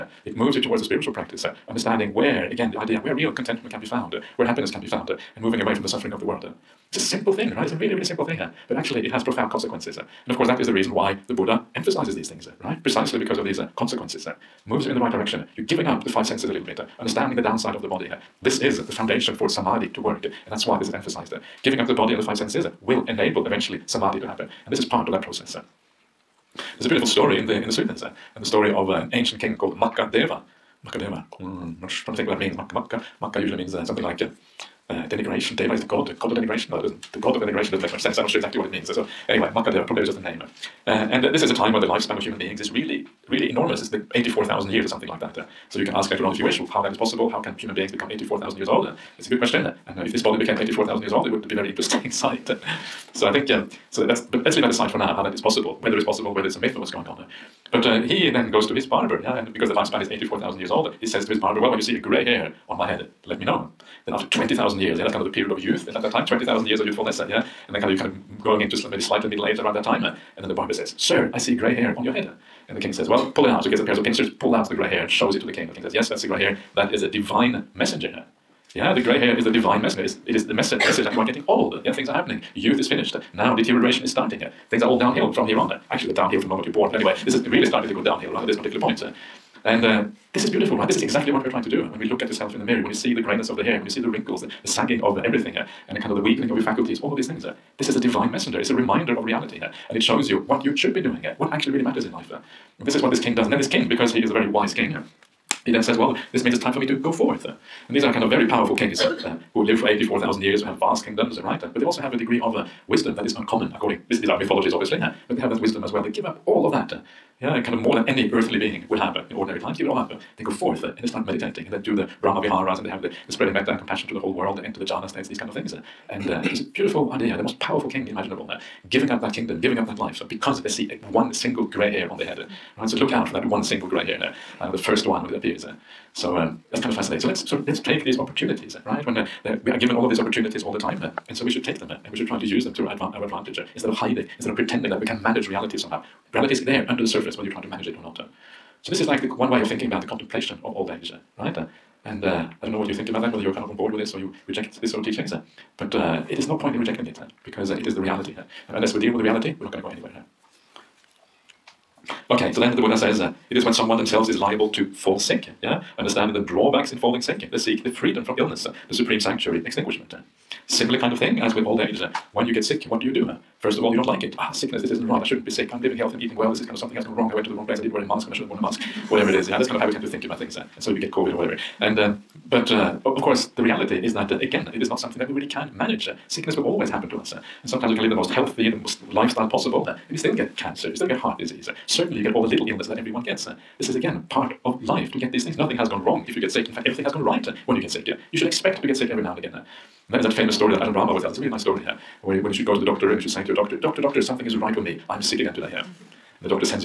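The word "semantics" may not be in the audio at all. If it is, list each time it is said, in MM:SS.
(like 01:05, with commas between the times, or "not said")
not said.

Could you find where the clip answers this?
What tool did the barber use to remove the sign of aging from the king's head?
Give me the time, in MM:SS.
01:14.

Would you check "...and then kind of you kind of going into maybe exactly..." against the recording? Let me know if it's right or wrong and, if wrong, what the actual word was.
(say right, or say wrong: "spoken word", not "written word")
wrong: "slightly", not "exactly".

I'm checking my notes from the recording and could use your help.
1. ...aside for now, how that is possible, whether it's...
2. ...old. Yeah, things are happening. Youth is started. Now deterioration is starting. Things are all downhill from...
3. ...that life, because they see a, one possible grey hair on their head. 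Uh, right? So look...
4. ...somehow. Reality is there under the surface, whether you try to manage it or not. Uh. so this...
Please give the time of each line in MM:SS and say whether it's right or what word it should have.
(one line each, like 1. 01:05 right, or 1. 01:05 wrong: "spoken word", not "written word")
1. 00:54 right
2. 01:21 wrong: "finished", not "started"
3. 02:09 wrong: "single", not "possible"
4. 02:25 right.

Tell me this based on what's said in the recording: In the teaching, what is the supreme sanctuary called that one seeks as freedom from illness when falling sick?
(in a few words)
extinguishment.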